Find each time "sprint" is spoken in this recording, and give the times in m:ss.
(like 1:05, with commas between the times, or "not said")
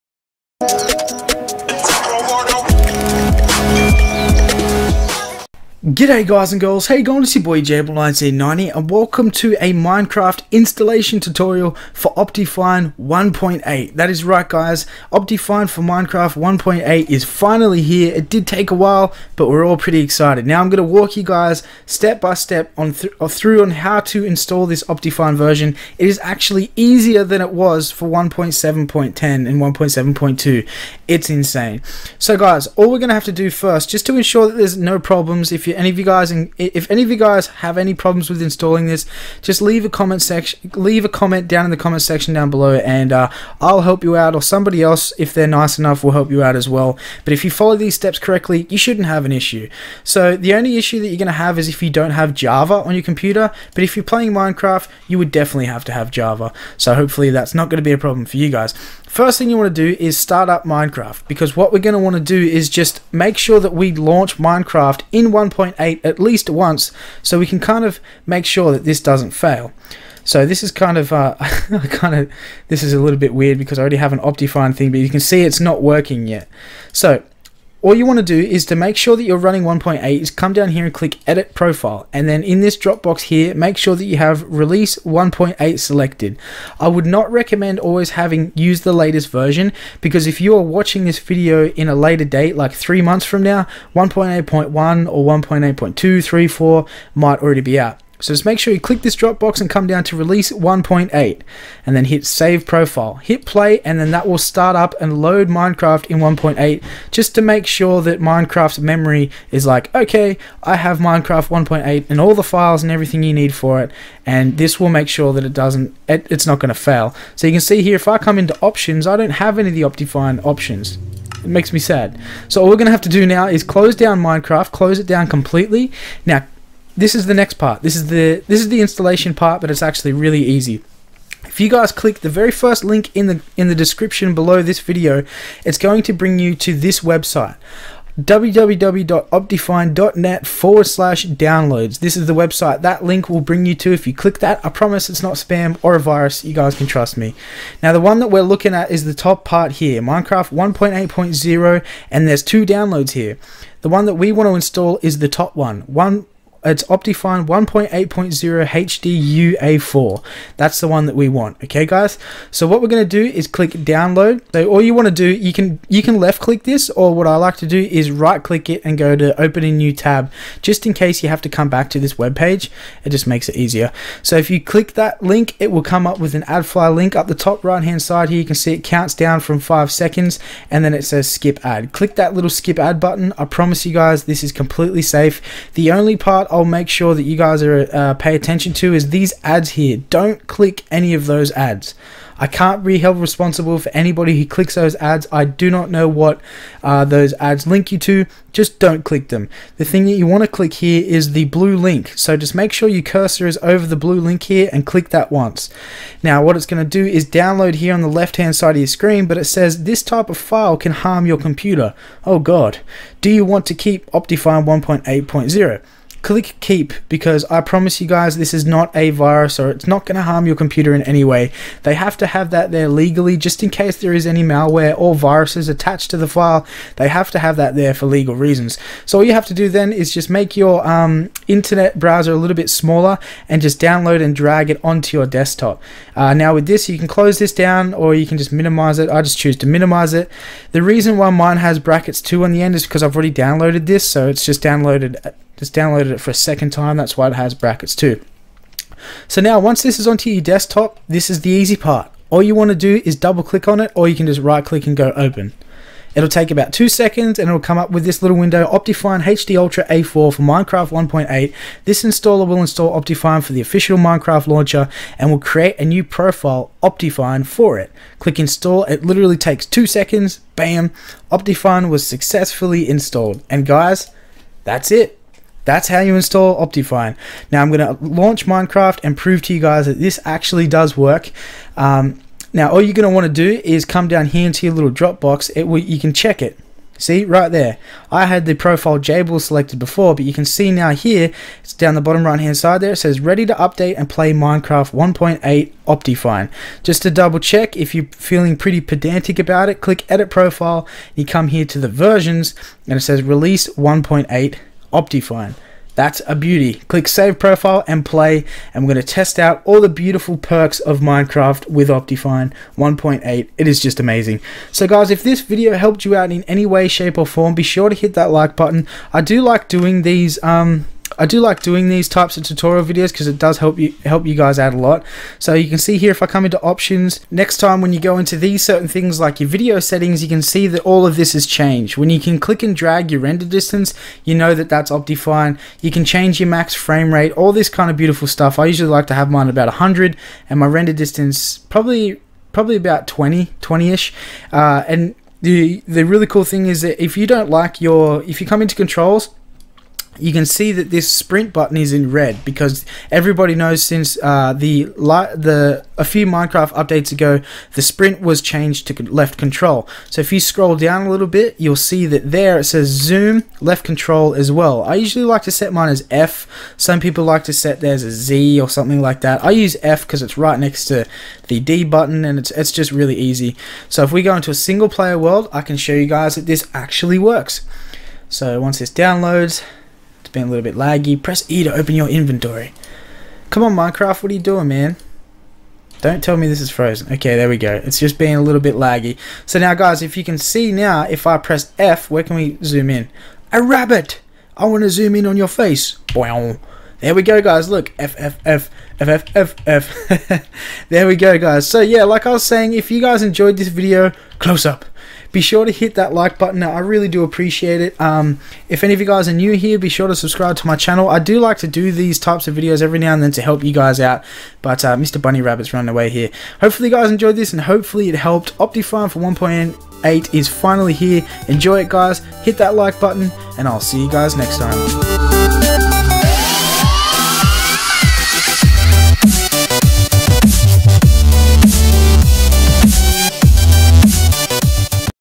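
5:51, 5:57.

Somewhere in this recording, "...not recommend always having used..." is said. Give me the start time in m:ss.
1:27.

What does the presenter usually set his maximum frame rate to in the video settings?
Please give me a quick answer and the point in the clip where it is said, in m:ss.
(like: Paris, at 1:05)
100, at 5:39.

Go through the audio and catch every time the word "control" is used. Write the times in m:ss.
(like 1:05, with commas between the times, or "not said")
5:48, 5:59, 6:03.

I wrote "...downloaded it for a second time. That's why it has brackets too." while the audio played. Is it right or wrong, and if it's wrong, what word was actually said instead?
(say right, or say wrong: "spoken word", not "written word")
right.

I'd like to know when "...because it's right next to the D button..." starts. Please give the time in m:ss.
6:10.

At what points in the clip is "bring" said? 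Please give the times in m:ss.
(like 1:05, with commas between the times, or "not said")
2:16, 2:23.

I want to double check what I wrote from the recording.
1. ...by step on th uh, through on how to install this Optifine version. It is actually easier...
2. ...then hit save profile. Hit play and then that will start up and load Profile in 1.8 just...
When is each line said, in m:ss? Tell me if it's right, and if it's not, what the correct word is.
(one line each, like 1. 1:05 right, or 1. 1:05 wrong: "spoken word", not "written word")
1. 0:22 right
2. 1:41 wrong: "Minecraft", not "Profile".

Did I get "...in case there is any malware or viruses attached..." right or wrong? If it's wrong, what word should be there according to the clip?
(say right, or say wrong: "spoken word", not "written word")
right.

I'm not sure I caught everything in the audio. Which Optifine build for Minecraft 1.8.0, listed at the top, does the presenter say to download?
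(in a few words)
Optifine 1.8.0 HDUA4.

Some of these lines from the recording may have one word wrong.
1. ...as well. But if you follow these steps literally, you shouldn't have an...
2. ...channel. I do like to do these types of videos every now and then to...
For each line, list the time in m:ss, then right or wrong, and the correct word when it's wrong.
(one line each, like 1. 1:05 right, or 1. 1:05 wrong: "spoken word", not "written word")
1. 0:46 wrong: "correctly", not "literally"
2. 6:50 right.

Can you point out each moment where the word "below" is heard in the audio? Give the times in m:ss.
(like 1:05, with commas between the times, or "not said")
0:42, 2:14.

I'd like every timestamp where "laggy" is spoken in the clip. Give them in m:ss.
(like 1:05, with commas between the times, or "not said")
6:20, 6:28.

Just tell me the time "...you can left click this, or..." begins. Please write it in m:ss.
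2:45.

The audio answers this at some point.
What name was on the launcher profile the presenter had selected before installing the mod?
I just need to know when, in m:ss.
4:48.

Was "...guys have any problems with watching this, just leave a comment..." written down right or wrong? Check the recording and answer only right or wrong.
wrong.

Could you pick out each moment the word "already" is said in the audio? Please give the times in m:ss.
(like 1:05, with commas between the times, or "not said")
1:13, 1:37, 4:03.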